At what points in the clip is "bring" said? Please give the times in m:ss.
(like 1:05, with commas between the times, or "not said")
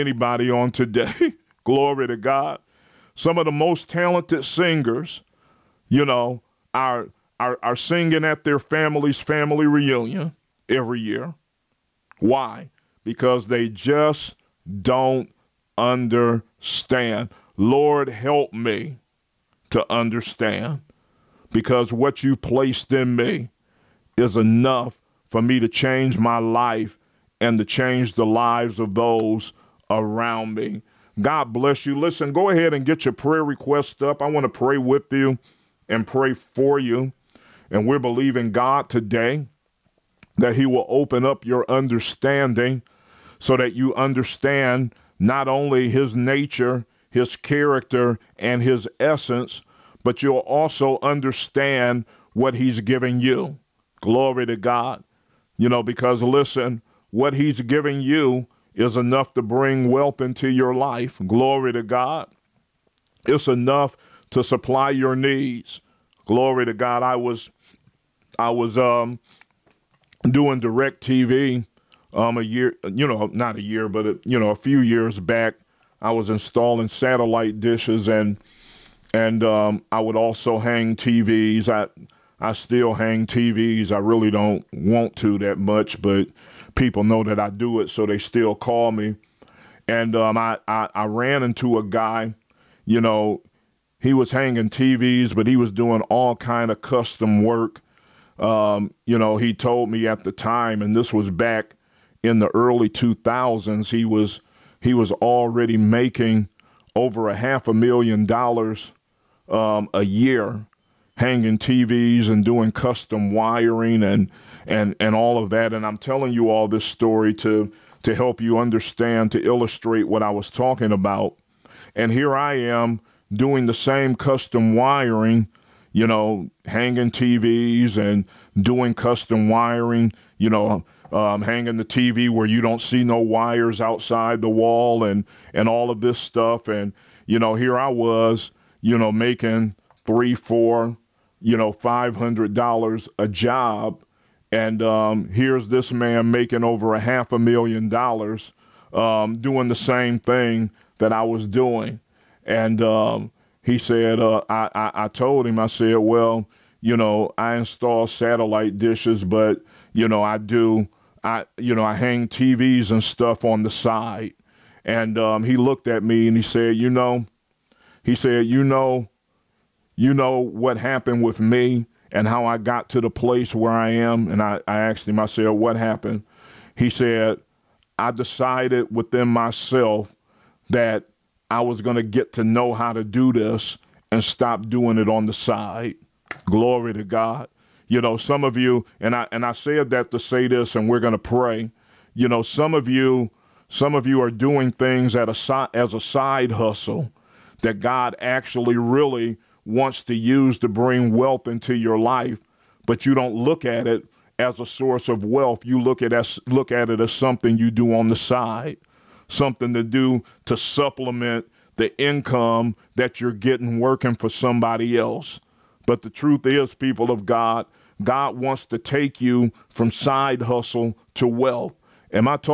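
0:59, 3:20.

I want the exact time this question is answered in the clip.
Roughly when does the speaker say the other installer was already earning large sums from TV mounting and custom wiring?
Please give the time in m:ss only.
1:42.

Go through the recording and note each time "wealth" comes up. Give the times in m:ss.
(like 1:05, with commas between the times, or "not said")
0:59, 3:21, 3:25, 3:41.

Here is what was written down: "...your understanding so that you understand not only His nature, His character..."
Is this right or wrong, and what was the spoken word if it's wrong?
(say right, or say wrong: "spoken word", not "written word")
right.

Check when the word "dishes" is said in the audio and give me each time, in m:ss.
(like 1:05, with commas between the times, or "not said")
1:17, 2:38.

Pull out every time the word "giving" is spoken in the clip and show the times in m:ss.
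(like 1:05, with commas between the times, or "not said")
0:52, 0:57.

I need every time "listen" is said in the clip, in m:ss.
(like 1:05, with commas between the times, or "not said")
0:31, 0:56.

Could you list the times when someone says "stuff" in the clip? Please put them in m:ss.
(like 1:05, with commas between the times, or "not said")
2:16, 2:43.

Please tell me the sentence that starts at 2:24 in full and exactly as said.
And um, here's this man making over a half a million dollars um, doing the same thing that I was doing.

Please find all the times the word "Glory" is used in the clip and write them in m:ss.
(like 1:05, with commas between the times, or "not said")
0:01, 0:54, 1:01, 1:06, 3:06.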